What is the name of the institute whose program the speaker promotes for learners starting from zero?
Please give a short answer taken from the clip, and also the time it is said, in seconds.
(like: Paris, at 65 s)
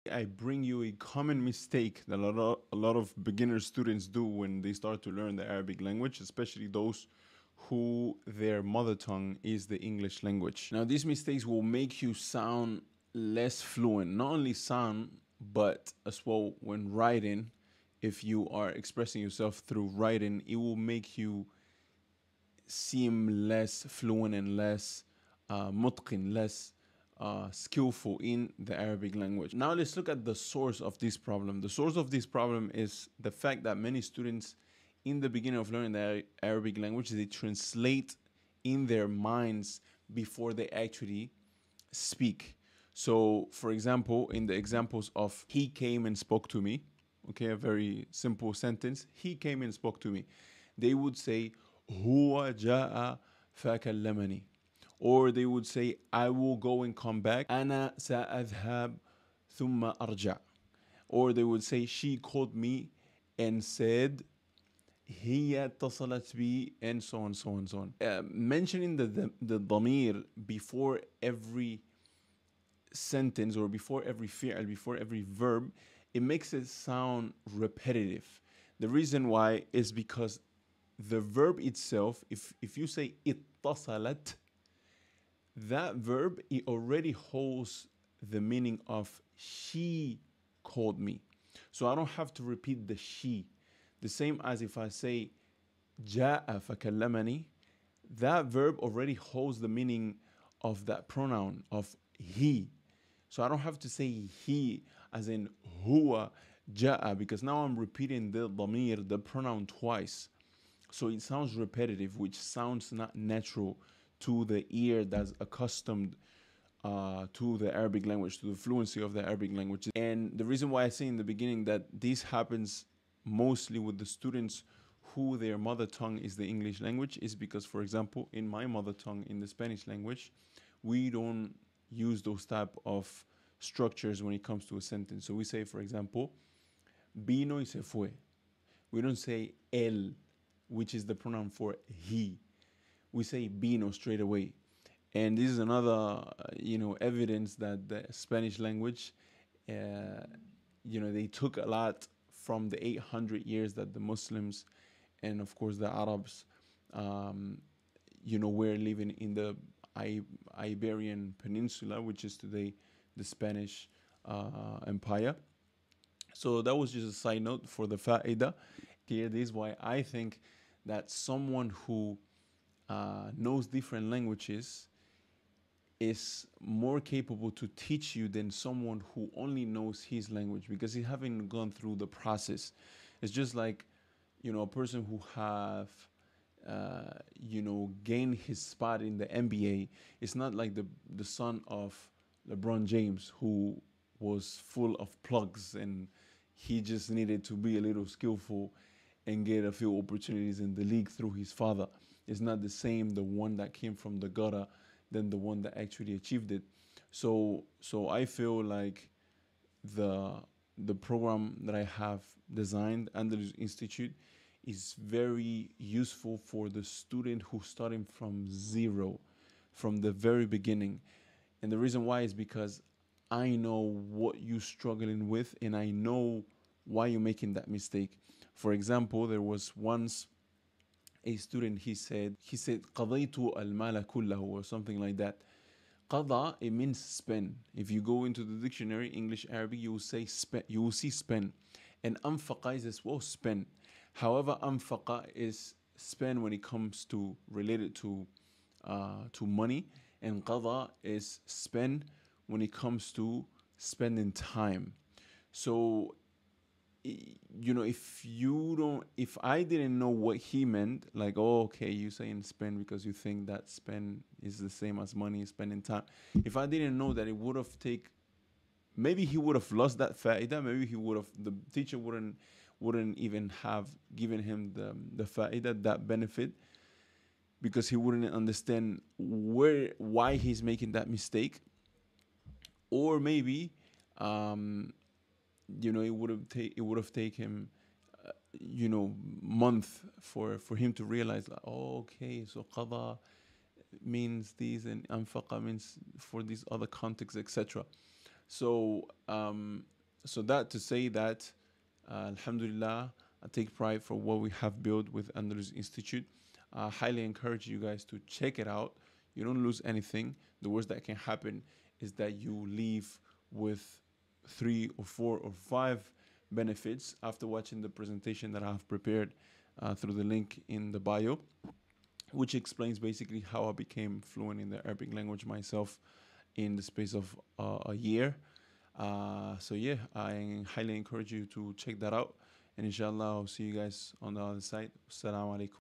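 Andalus Institute, at 305 s.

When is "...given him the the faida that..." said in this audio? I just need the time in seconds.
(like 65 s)
274 s.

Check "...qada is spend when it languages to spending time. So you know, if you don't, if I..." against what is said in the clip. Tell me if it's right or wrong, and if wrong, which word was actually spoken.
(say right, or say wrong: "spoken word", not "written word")
wrong: "comes", not "languages".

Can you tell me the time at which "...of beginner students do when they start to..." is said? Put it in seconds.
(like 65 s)
2 s.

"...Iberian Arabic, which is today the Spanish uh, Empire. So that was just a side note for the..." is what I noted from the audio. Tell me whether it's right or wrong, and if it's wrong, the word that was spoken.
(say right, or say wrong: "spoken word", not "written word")
wrong: "Peninsula", not "Arabic".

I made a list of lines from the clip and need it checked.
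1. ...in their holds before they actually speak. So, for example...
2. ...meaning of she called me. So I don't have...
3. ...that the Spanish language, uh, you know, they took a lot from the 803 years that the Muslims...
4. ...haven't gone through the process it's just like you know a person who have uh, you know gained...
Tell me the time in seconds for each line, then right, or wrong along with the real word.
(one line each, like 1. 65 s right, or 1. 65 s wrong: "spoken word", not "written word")
1. 38 s wrong: "minds", not "holds"
2. 88 s right
3. 147 s wrong: "800", not "803"
4. 181 s right.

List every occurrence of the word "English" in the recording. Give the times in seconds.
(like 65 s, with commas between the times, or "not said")
9 s, 126 s, 239 s.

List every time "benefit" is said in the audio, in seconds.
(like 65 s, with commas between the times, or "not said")
276 s, 316 s.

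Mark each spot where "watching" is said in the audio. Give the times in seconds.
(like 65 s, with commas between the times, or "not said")
317 s.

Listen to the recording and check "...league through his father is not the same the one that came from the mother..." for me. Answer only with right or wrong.
wrong.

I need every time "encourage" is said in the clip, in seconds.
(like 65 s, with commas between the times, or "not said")
307 s, 330 s.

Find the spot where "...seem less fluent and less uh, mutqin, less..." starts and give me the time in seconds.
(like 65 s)
22 s.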